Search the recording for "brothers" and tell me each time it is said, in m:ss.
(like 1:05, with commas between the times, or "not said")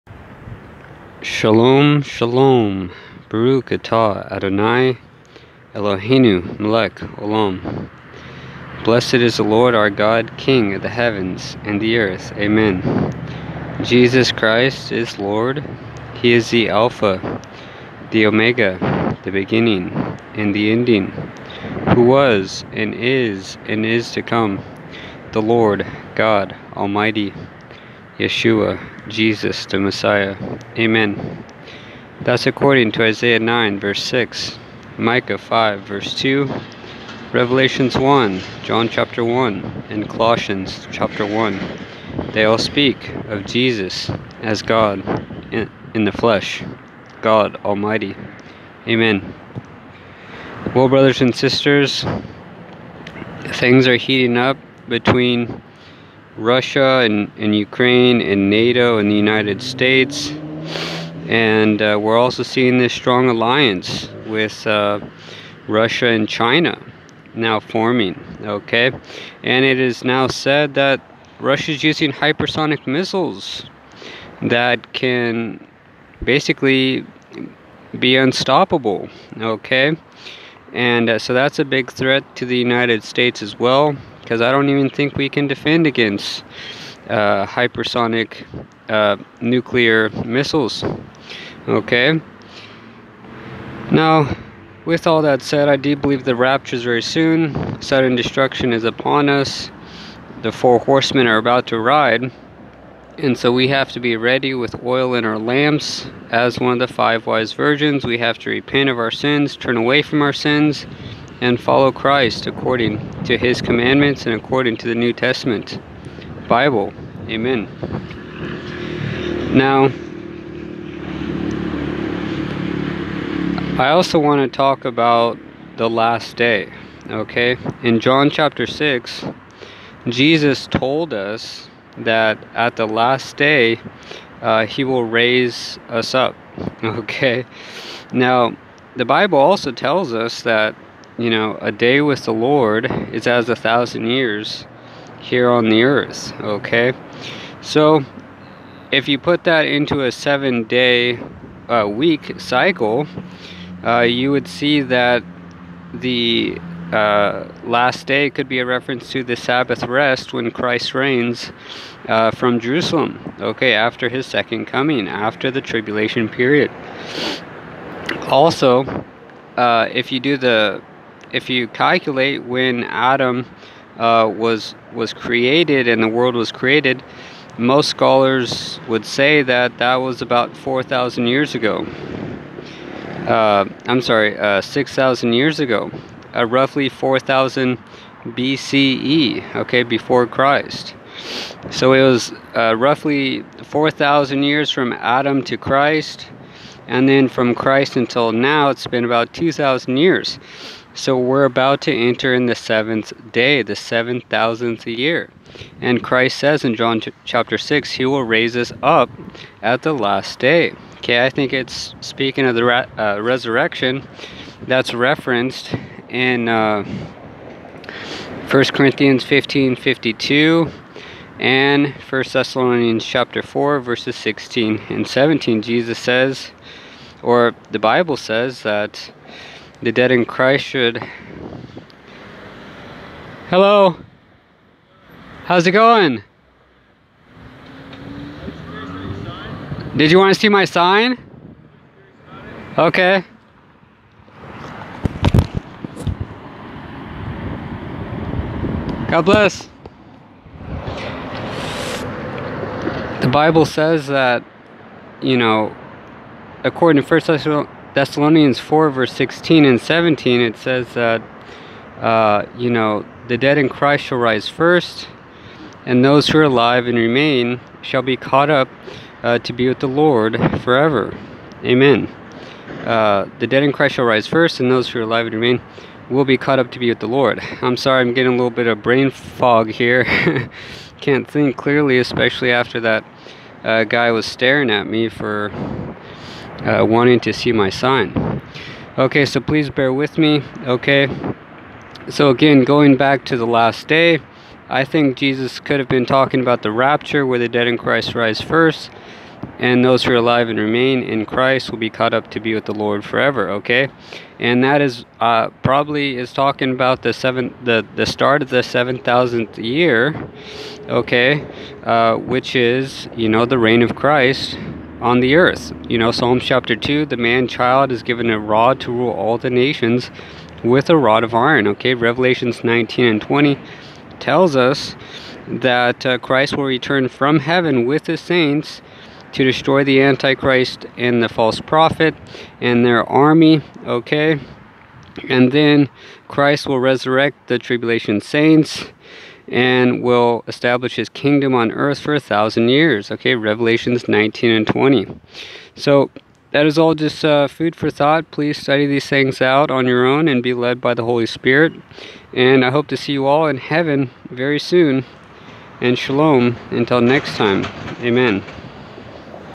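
0:50.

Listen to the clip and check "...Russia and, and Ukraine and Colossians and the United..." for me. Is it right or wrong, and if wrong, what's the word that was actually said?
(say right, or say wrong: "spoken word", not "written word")
wrong: "NATO", not "Colossians".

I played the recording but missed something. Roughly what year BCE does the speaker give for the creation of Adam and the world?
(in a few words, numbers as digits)
4,000 BCE.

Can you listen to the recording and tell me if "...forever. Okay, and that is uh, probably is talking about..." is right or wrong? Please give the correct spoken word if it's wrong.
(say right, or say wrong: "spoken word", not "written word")
right.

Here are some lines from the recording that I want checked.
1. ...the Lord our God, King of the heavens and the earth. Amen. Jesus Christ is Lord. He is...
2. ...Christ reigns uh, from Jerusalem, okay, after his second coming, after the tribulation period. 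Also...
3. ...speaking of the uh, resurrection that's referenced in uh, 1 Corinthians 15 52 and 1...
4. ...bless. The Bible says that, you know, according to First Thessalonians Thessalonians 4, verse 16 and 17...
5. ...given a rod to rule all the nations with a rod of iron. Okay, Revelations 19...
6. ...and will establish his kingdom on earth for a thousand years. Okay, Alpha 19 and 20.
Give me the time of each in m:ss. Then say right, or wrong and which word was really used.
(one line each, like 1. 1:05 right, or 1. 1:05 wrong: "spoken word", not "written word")
1. 0:09 right
2. 2:40 right
3. 3:32 right
4. 4:09 right
5. 5:18 right
6. 5:39 wrong: "Revelations", not "Alpha".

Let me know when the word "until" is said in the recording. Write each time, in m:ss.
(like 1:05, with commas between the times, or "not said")
3:17, 5:56.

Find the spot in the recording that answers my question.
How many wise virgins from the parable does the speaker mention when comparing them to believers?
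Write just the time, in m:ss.
1:46.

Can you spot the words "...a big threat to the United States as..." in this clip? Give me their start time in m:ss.
1:21.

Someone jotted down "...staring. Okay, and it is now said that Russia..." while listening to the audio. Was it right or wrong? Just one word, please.
wrong.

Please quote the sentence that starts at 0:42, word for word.
They all speak of Jesus as God in the flesh, God Almighty.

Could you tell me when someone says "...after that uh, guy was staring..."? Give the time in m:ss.
4:42.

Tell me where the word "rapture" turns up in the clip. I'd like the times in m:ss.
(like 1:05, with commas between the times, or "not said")
1:36, 4:56.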